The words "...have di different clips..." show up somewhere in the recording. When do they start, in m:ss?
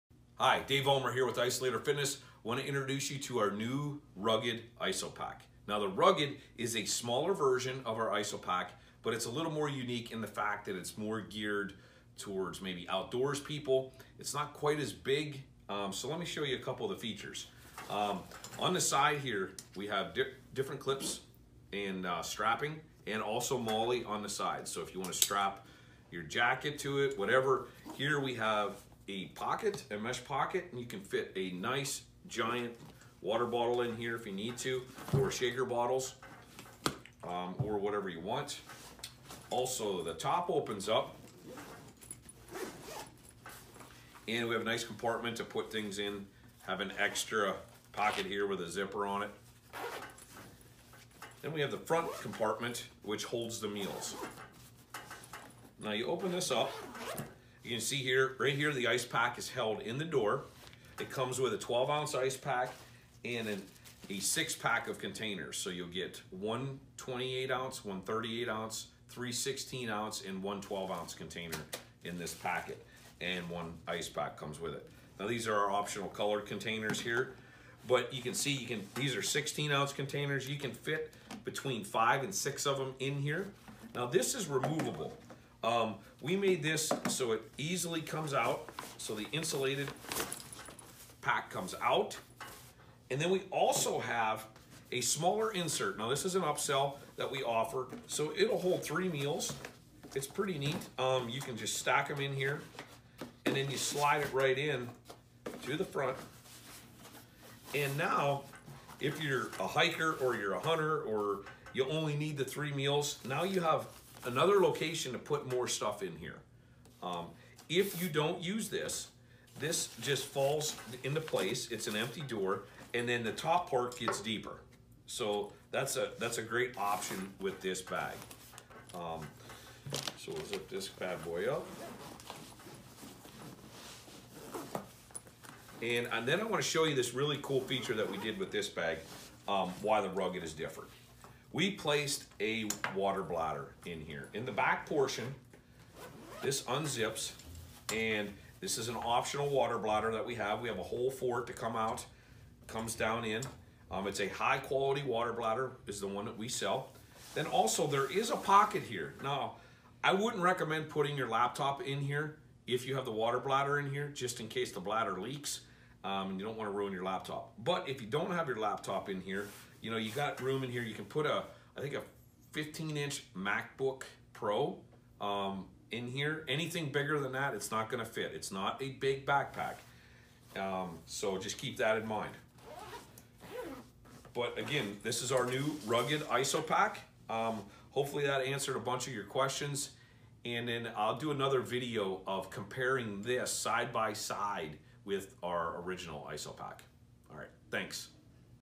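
0:19.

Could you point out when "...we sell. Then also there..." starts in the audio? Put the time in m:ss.
2:36.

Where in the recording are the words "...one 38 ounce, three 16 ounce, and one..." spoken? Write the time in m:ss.
1:07.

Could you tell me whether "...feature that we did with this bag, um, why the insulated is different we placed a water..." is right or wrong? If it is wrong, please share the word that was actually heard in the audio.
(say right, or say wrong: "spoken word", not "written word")
wrong: "rugged", not "insulated".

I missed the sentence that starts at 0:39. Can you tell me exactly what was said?
Also, the top opens up, and we have a nice compartment to put things in.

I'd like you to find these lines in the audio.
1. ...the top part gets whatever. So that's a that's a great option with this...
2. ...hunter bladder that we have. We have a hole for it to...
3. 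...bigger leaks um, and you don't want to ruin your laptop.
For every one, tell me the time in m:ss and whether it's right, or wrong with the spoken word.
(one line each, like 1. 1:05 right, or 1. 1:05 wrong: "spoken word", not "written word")
1. 2:03 wrong: "deeper", not "whatever"
2. 2:29 wrong: "water", not "hunter"
3. 2:44 wrong: "bladder", not "bigger".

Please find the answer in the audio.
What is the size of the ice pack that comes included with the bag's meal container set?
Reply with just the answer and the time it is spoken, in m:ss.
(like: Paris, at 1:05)
12 ounce, at 1:01.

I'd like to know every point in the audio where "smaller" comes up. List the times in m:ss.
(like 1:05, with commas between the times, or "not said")
0:06, 1:35.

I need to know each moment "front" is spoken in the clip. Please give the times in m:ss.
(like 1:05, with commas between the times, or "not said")
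0:51, 1:45.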